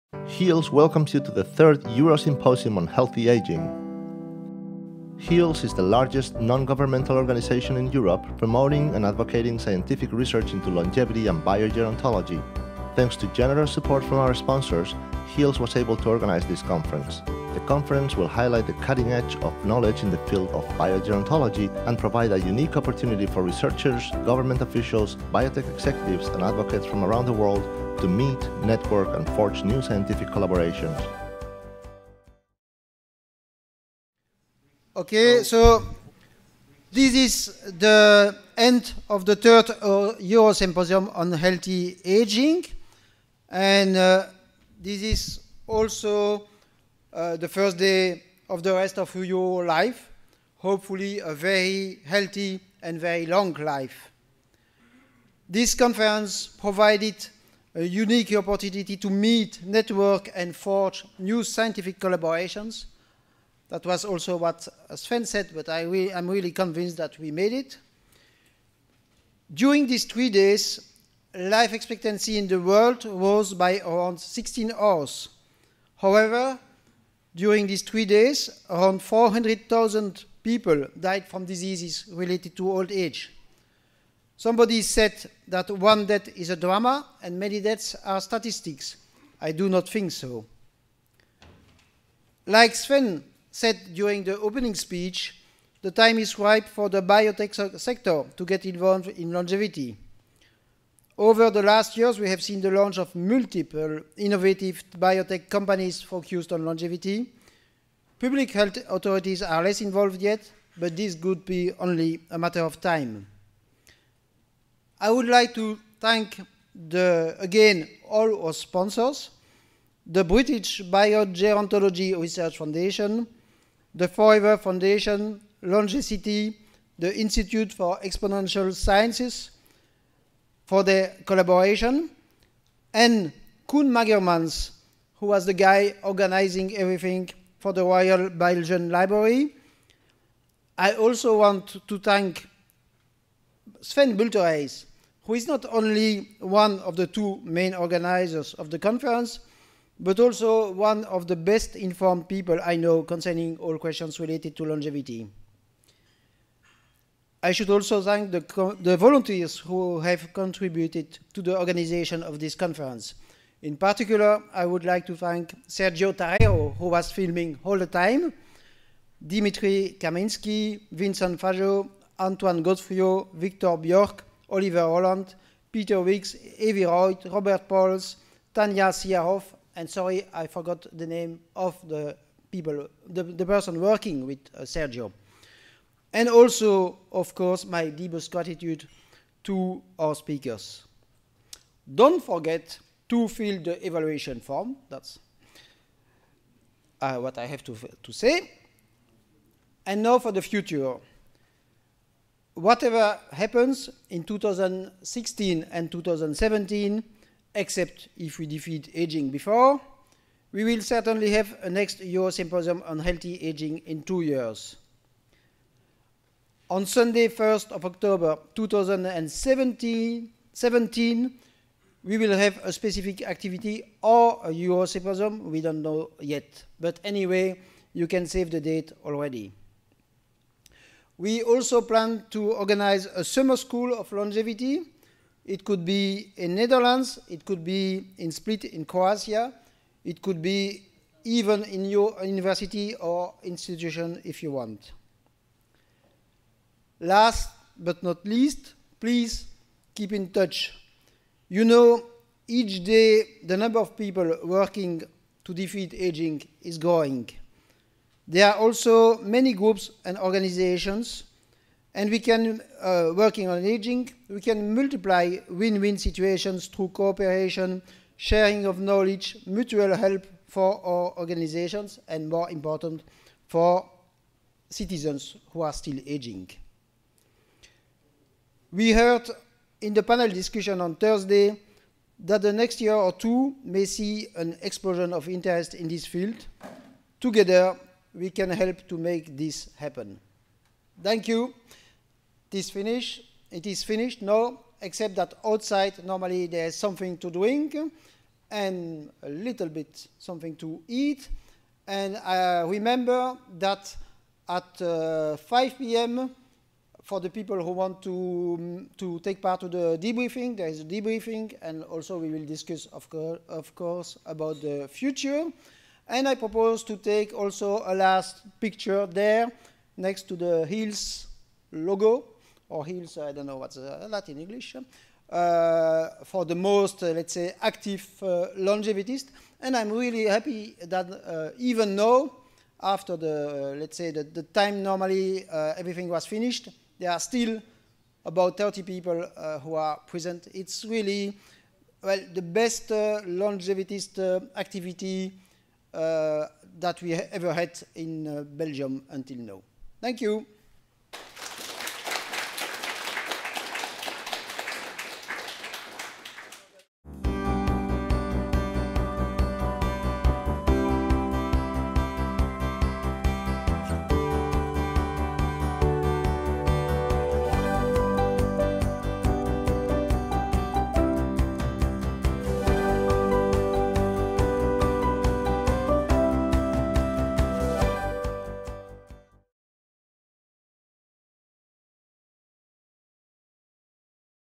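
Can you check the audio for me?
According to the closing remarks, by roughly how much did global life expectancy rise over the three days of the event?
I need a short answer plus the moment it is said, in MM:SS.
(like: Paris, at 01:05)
16 hours, at 01:14.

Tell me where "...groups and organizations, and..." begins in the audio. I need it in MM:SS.
04:19.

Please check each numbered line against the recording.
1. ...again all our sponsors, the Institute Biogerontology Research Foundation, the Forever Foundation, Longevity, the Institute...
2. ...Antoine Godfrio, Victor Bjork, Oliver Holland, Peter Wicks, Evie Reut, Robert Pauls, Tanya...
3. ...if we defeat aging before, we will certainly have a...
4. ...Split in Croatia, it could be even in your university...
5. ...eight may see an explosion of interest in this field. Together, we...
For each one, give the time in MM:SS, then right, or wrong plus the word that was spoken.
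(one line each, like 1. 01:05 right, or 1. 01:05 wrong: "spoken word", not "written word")
1. 01:57 wrong: "British", not "Institute"
2. 02:52 right
3. 03:28 right
4. 03:58 right
5. 04:43 wrong: "two", not "eight".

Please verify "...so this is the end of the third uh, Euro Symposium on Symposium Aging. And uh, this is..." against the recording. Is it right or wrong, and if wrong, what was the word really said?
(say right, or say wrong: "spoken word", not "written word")
wrong: "Healthy", not "Symposium".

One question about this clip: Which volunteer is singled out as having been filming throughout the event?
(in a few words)
Sergio Tarrero.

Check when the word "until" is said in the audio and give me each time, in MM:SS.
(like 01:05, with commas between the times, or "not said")
05:49.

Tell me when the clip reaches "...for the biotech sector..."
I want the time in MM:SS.
01:36.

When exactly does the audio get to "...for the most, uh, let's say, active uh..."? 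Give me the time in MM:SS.
05:26.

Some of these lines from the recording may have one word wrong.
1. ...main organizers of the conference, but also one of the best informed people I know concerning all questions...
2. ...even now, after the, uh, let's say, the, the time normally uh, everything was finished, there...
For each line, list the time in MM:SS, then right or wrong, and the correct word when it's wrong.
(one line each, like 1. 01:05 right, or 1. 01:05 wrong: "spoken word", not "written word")
1. 02:27 right
2. 05:31 right.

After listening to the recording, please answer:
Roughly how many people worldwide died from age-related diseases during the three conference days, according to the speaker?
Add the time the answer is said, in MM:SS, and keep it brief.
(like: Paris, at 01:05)
400,000, at 01:19.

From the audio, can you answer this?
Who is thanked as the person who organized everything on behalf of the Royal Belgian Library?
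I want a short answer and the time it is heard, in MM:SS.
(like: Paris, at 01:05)
Koen Magermans, at 02:13.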